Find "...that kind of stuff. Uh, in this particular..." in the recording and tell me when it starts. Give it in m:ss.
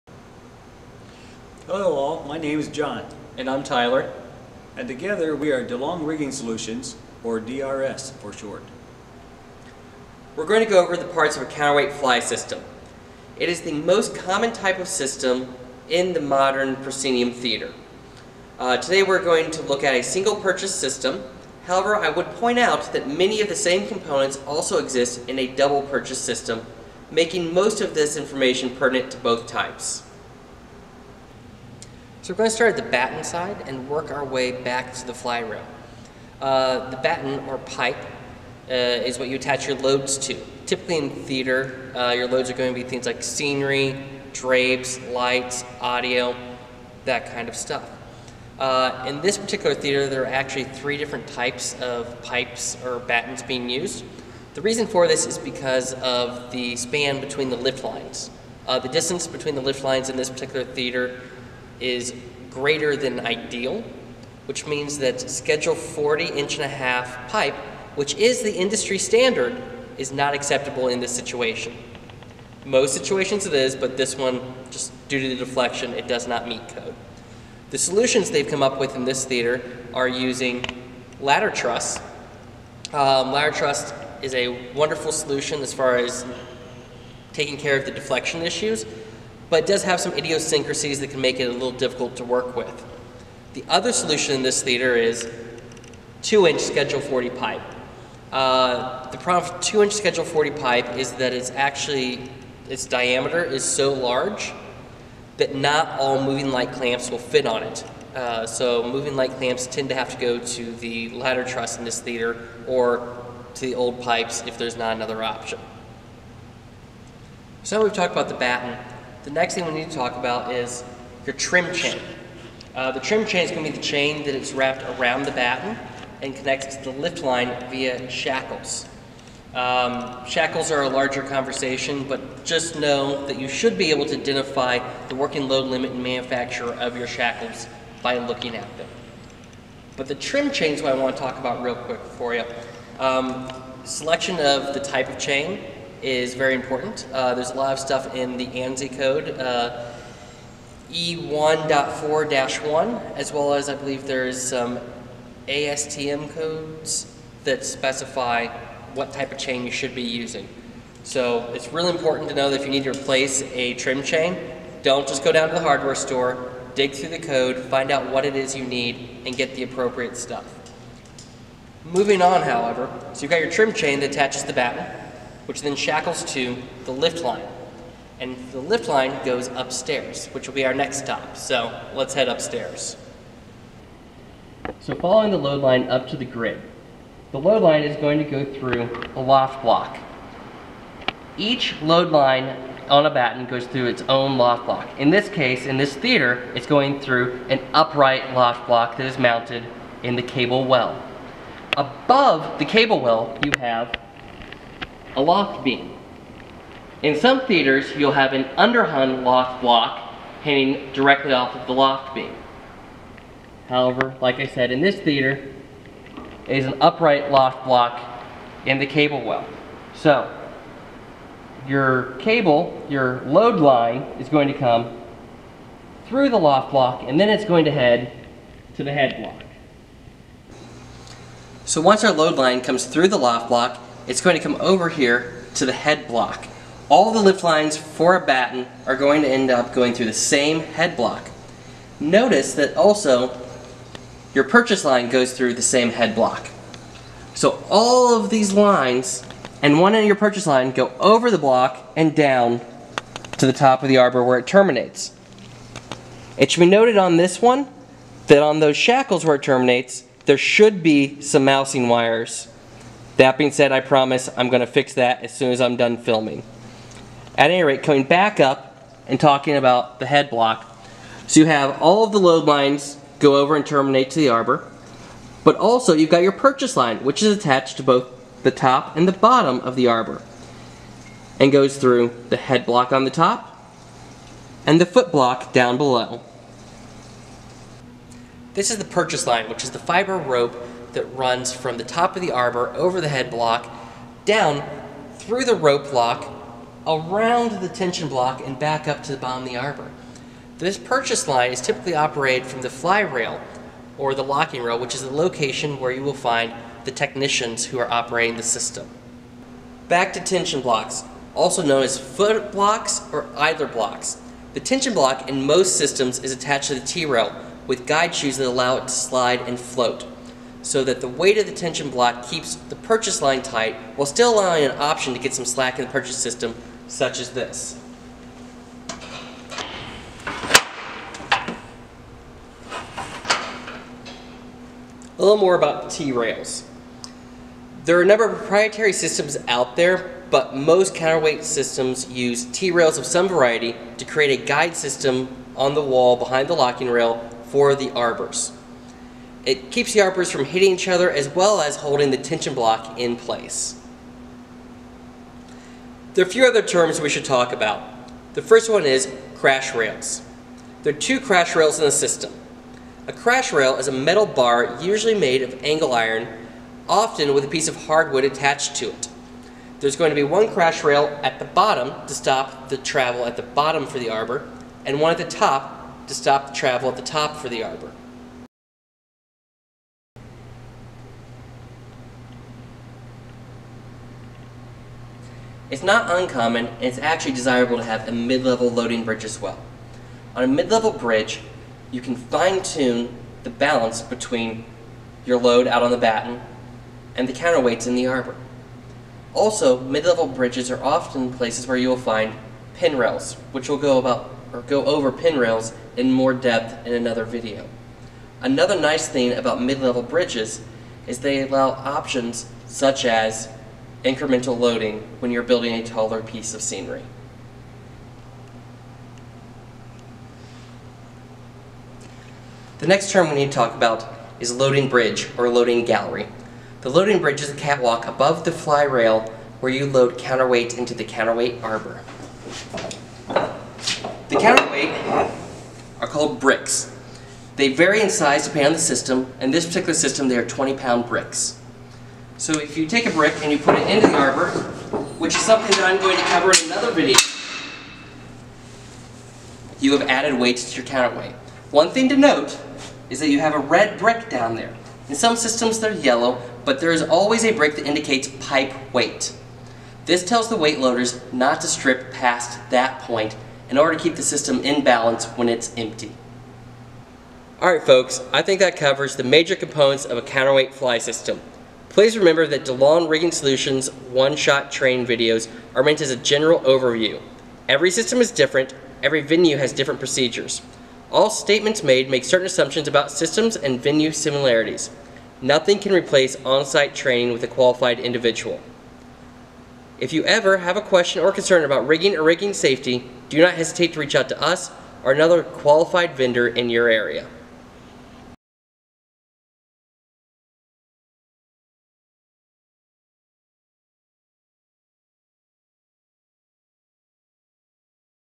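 0:47.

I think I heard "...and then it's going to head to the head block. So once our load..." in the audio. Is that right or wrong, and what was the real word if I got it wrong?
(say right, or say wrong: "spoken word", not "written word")
right.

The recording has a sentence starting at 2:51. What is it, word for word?
Moving on, however, so you've got your trim chain that attaches the batten, which then shackles to the lift line.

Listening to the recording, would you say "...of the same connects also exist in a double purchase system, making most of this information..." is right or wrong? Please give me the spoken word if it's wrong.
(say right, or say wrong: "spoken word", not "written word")
wrong: "components", not "connects".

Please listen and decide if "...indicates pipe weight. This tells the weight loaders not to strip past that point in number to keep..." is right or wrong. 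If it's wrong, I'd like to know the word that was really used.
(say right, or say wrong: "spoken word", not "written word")
wrong: "order", not "number".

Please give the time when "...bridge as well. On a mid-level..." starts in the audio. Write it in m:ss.
6:29.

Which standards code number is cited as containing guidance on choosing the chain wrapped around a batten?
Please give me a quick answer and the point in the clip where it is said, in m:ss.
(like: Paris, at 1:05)
E1.4-1, at 2:30.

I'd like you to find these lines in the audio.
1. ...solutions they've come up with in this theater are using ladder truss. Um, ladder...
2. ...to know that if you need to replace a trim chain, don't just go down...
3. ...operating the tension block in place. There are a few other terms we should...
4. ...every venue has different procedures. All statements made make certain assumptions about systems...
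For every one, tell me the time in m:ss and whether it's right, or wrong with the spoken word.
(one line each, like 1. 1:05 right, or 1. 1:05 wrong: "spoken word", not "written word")
1. 1:17 right
2. 2:42 right
3. 5:51 wrong: "holding", not "operating"
4. 7:59 right.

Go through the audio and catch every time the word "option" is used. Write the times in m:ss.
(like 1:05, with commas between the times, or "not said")
1:55, 5:24, 6:51.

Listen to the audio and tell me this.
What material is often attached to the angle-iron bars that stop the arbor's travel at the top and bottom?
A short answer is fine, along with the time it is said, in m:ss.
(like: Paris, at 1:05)
Hardwood, at 6:07.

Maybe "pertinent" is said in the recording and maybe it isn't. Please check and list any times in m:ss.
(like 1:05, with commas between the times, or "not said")
0:28.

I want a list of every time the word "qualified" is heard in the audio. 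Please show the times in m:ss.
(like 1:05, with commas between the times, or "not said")
8:07, 8:15.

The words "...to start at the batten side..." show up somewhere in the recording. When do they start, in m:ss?
0:32.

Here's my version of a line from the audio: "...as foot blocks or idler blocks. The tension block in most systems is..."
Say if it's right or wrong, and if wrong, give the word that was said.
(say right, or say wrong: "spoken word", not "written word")
right.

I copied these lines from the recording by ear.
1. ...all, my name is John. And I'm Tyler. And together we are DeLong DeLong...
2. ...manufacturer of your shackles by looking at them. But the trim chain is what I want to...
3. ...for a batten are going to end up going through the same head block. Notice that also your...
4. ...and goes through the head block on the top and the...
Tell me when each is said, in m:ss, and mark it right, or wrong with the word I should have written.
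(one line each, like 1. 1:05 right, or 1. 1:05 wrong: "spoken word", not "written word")
1. 0:01 wrong: "Rigging", not "DeLong"
2. 2:16 right
3. 3:57 right
4. 4:41 right.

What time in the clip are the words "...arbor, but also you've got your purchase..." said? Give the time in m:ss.
4:34.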